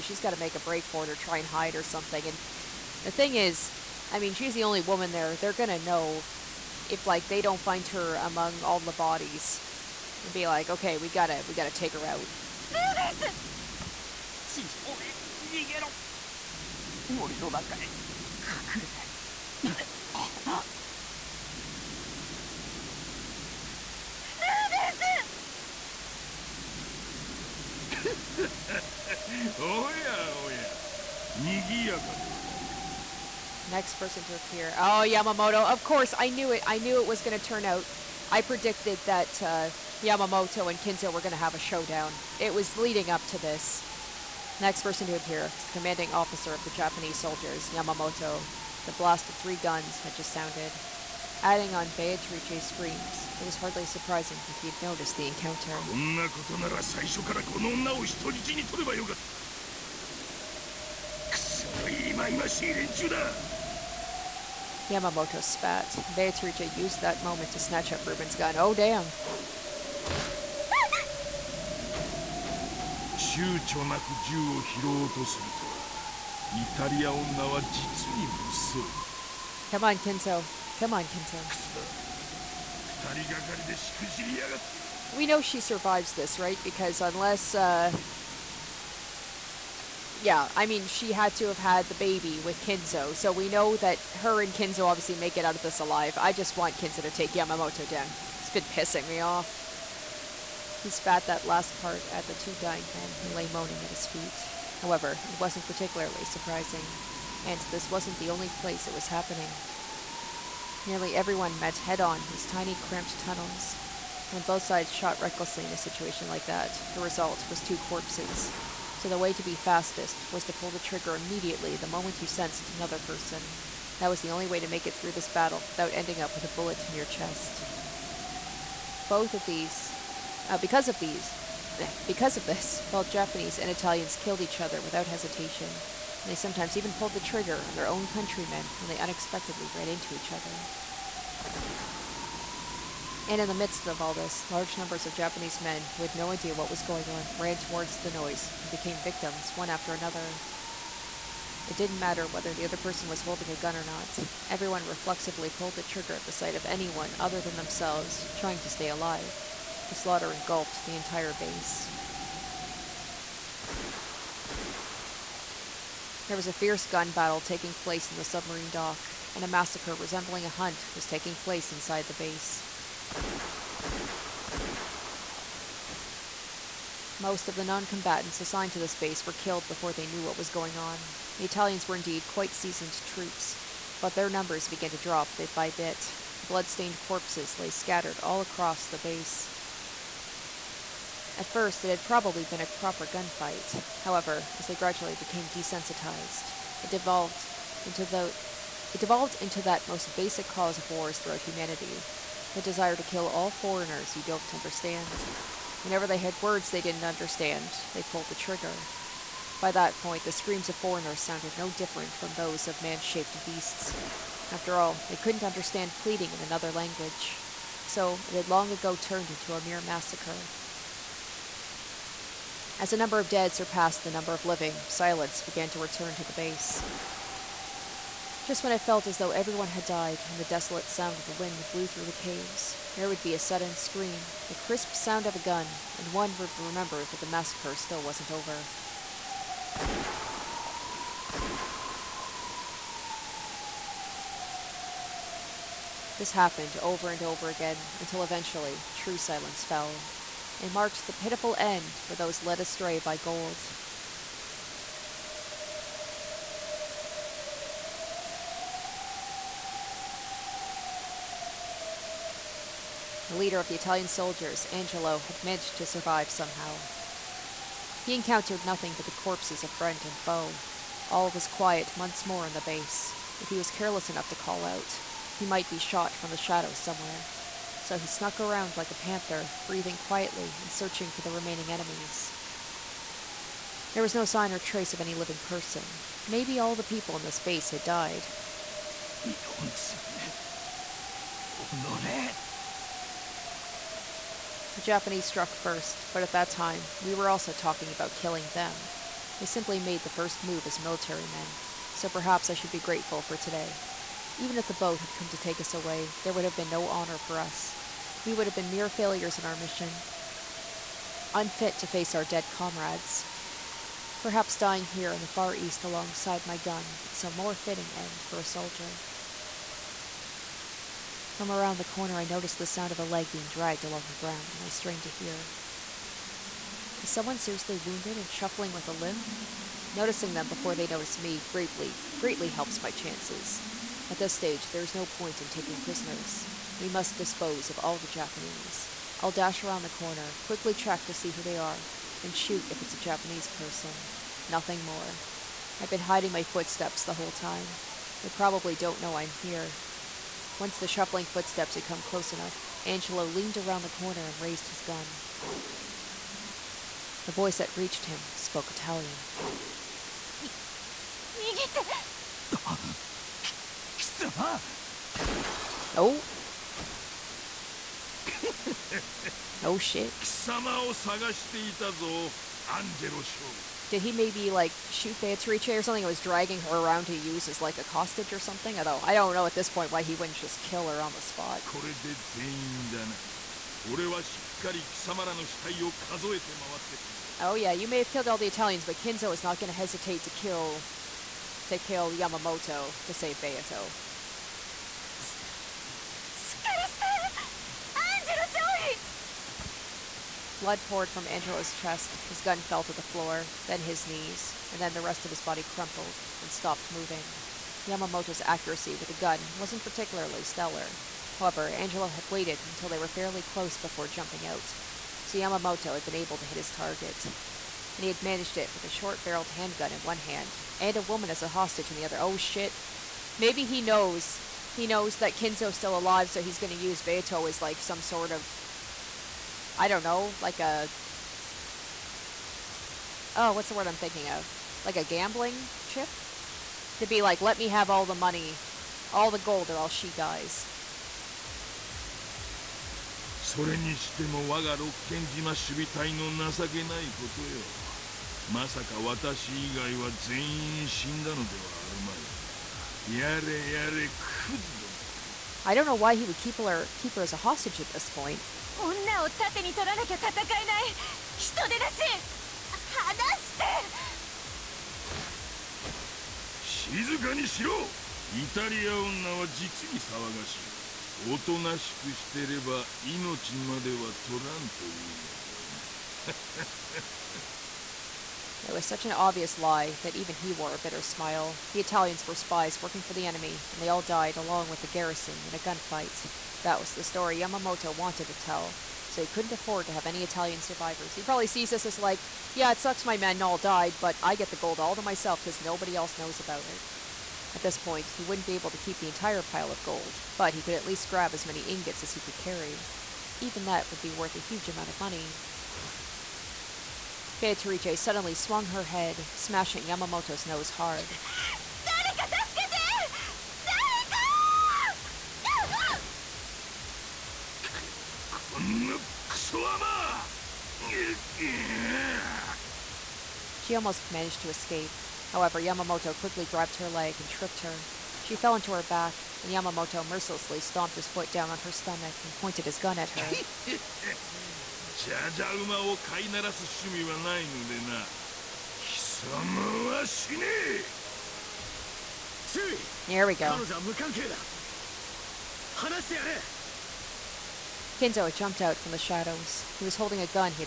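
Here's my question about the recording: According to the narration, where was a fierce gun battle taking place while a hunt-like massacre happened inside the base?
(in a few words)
submarine dock.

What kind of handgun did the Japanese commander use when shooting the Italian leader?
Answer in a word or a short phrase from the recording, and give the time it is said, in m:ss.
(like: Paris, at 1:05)
short-barreled handgun, at 6:58.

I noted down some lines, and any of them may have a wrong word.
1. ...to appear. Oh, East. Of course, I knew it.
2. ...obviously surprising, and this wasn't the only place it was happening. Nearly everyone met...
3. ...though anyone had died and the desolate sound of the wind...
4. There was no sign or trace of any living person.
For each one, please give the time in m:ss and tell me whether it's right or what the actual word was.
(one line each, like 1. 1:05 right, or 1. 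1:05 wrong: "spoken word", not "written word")
1. 0:34 wrong: "Yamamoto", not "East"
2. 1:45 wrong: "particularly", not "obviously"
3. 3:49 wrong: "everyone", not "anyone"
4. 4:43 right.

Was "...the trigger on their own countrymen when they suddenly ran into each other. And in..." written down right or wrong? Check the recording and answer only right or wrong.
wrong.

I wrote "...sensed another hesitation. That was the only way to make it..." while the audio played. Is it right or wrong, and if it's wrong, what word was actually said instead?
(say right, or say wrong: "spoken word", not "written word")
wrong: "person", not "hesitation".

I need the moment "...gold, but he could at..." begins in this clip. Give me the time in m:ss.
8:19.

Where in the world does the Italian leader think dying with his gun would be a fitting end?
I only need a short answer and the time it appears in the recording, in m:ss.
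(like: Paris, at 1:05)
the Far East, at 5:15.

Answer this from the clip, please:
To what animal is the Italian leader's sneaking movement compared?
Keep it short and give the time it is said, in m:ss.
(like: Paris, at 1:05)
a panther, at 4:38.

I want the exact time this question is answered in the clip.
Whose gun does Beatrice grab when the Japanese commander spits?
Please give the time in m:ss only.
1:08.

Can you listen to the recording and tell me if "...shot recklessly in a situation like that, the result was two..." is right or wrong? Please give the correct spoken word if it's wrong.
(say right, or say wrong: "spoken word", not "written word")
right.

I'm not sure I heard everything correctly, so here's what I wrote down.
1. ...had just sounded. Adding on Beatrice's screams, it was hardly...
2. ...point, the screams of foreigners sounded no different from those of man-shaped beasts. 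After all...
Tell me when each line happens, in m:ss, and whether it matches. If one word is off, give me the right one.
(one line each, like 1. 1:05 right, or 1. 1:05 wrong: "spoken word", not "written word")
1. 0:49 right
2. 3:30 right.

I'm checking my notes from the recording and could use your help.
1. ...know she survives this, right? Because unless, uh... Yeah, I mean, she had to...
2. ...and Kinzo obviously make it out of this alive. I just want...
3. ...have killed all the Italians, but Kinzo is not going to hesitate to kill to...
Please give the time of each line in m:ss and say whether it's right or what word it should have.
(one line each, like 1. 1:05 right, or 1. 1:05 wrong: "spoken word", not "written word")
1. 1:25 right
2. 1:34 right
3. 6:27 right.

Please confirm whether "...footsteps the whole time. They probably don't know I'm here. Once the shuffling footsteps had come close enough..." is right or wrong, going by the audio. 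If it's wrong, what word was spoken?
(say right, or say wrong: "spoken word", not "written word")
right.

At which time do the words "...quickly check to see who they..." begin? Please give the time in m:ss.
5:40.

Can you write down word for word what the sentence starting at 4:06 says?
This happened over and over again until eventually true silence fell and marked the pitiful end for those led astray by gold.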